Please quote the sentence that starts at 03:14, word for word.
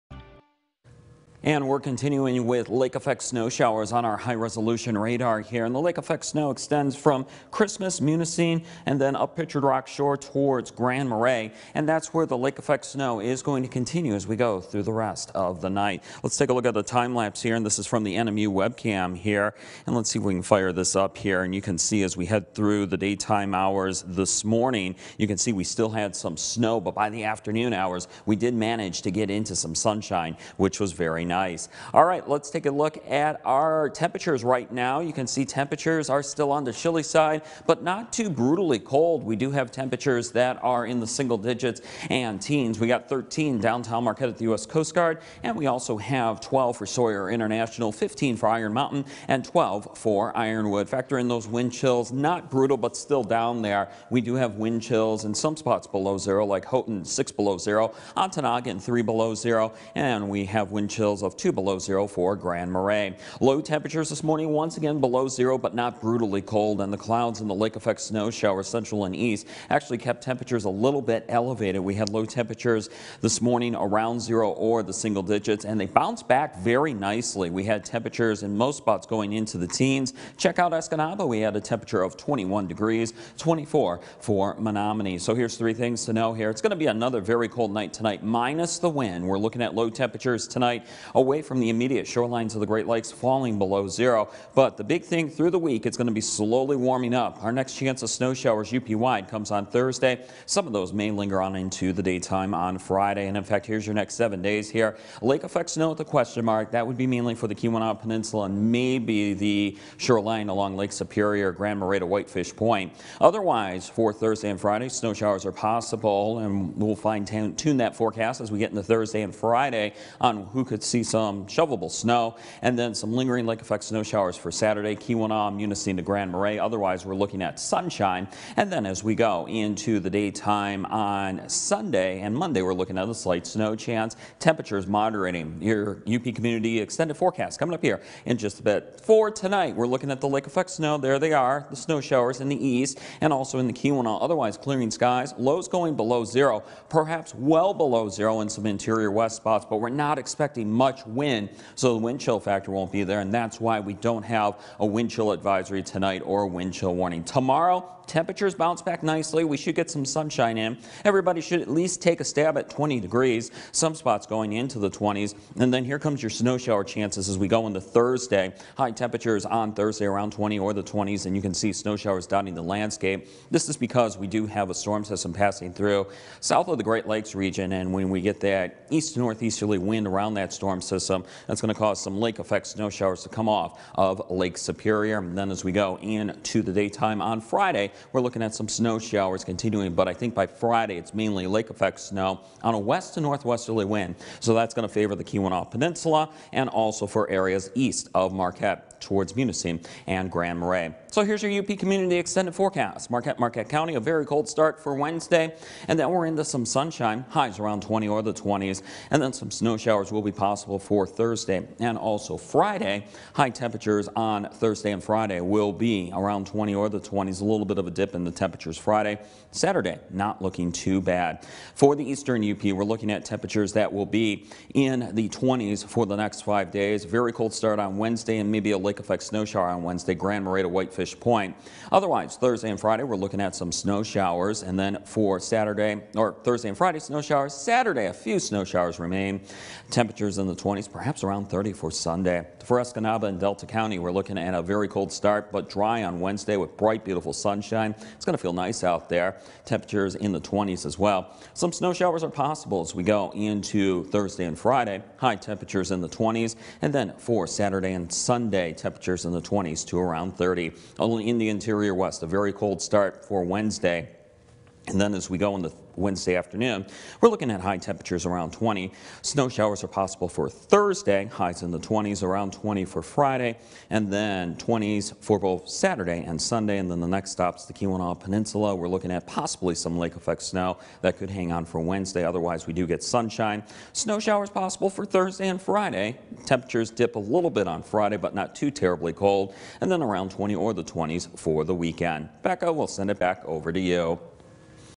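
So that's going to favor the Keweenaw Peninsula and also for areas east of Marquette towards Munising and Grand Marais.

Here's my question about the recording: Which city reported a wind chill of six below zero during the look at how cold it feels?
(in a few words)
Houghton.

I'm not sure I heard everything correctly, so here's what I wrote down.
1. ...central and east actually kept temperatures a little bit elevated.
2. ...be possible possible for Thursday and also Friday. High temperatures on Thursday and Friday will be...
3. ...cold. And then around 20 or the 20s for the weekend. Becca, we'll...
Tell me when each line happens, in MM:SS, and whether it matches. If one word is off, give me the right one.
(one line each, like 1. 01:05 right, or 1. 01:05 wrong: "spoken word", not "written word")
1. 01:08 right
2. 03:30 right
3. 04:49 right.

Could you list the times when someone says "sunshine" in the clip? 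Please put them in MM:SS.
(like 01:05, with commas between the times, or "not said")
00:29, 02:07, 02:40, 03:26, 04:07, 04:43.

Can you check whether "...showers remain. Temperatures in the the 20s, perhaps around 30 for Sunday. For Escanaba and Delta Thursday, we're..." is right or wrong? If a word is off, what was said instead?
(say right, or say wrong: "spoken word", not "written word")
wrong: "County", not "Thursday".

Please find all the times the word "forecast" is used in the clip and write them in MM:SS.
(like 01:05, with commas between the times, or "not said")
01:57, 02:17, 03:22.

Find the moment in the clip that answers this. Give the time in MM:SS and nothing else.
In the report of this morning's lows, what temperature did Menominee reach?
01:23.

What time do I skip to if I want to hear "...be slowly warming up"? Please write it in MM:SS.
01:36.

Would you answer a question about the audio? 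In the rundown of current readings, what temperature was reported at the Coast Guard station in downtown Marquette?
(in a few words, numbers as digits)
13.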